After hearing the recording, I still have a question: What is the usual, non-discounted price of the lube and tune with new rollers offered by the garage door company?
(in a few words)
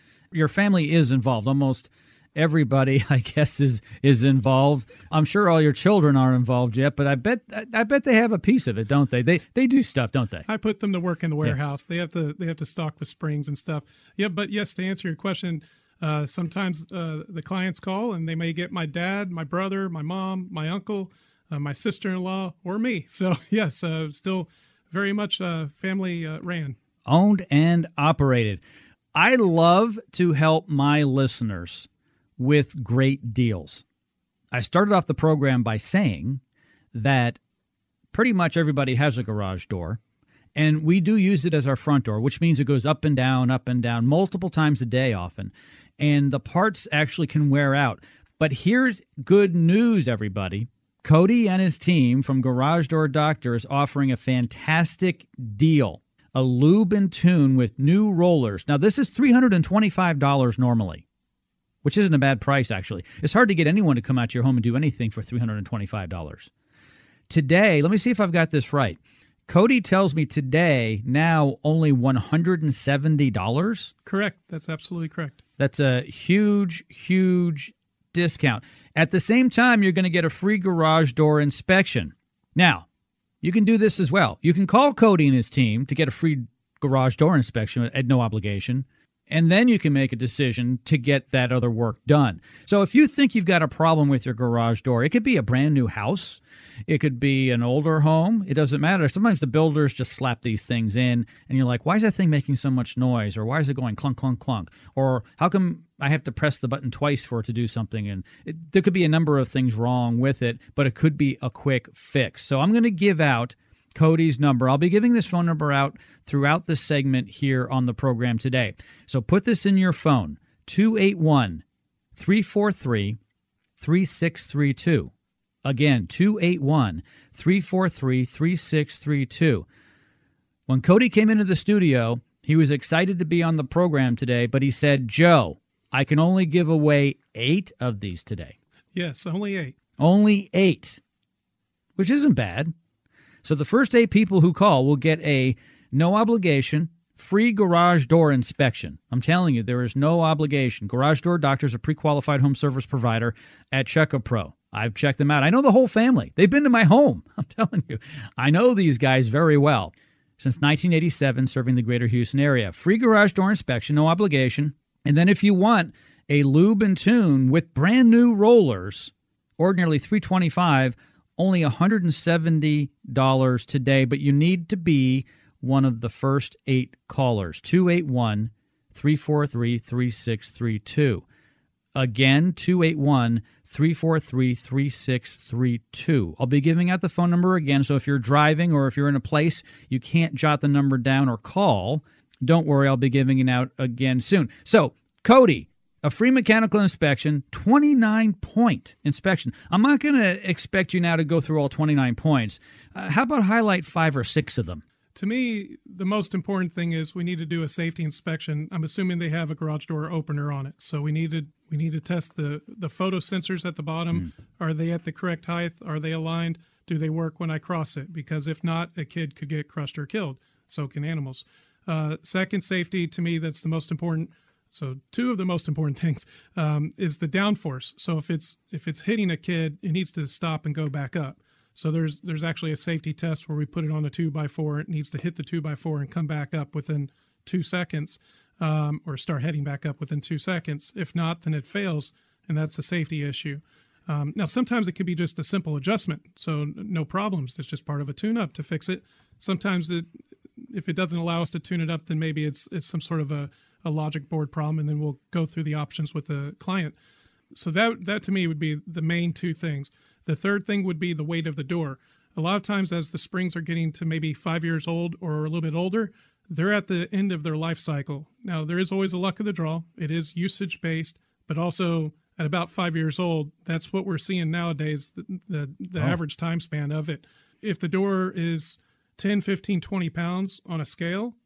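$325.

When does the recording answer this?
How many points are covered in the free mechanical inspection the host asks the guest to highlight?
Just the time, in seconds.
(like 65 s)
197 s.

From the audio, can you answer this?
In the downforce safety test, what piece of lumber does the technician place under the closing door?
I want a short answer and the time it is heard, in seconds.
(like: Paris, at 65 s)
a two by four, at 234 s.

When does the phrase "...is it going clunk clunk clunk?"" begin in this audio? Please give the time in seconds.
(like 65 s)
103 s.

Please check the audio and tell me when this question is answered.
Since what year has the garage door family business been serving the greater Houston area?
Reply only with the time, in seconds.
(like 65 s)
160 s.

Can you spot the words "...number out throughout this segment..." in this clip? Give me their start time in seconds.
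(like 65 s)
115 s.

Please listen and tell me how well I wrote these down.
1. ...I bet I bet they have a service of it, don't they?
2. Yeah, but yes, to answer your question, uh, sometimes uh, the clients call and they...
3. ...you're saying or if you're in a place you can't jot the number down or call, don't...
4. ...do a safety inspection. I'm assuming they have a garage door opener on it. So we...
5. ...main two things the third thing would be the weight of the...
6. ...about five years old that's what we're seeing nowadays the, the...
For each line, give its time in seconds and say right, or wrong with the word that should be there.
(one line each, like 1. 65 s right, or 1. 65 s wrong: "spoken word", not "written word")
1. 7 s wrong: "piece", not "service"
2. 14 s right
3. 188 s wrong: "driving", not "saying"
4. 207 s right
5. 259 s right
6. 272 s right.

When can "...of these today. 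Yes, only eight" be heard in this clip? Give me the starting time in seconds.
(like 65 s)
137 s.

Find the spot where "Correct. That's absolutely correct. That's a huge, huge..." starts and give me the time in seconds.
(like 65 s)
74 s.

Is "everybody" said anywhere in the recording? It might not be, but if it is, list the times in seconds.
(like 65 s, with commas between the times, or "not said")
2 s, 38 s, 50 s.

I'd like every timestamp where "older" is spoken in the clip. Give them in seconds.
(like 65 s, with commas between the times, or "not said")
97 s, 265 s.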